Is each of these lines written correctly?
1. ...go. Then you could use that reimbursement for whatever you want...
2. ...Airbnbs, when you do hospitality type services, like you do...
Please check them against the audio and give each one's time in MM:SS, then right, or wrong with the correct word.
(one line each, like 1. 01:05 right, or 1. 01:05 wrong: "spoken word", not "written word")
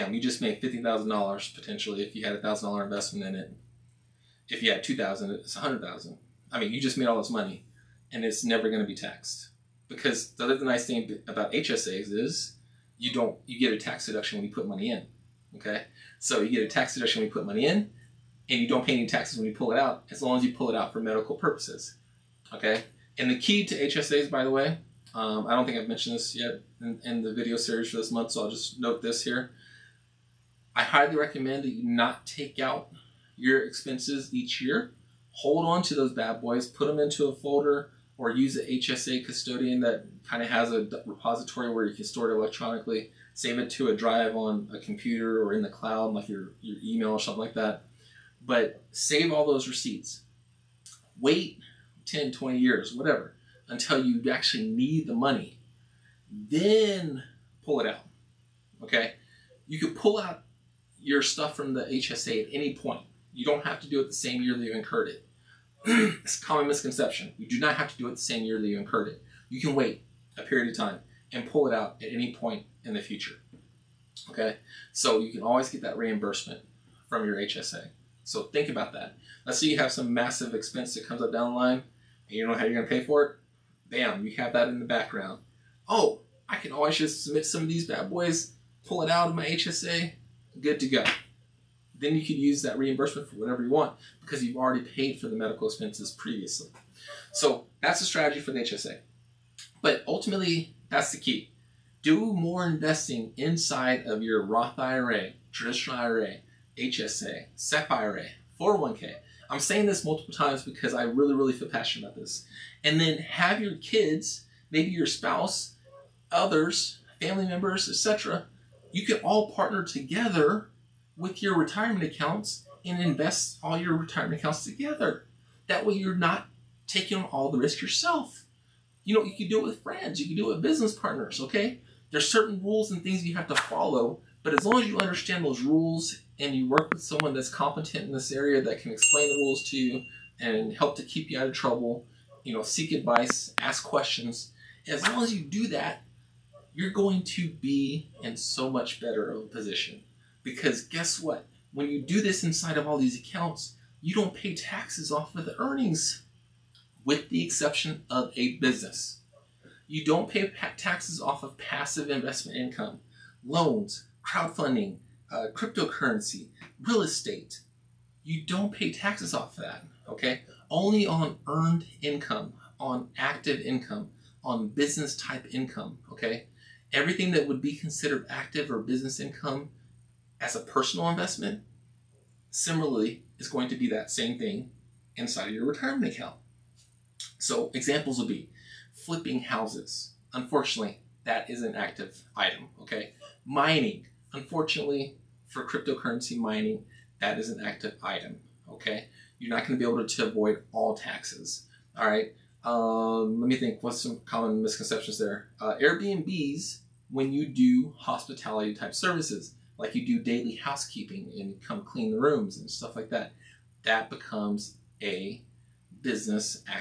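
1. 01:30 right
2. 03:25 right.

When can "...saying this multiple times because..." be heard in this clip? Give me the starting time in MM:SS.
01:49.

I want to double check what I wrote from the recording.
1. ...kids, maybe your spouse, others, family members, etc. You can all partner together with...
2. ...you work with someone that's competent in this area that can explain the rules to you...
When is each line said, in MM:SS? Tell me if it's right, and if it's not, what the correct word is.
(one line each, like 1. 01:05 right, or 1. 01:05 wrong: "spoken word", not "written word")
1. 01:53 right
2. 02:16 right.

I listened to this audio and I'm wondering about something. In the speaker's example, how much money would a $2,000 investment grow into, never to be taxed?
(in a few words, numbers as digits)
$100,000.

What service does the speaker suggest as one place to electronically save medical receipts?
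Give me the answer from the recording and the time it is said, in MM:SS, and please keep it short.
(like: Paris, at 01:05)
email, at 00:46.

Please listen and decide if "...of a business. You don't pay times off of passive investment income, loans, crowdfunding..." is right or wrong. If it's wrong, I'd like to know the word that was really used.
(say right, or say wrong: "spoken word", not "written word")
wrong: "taxes", not "times".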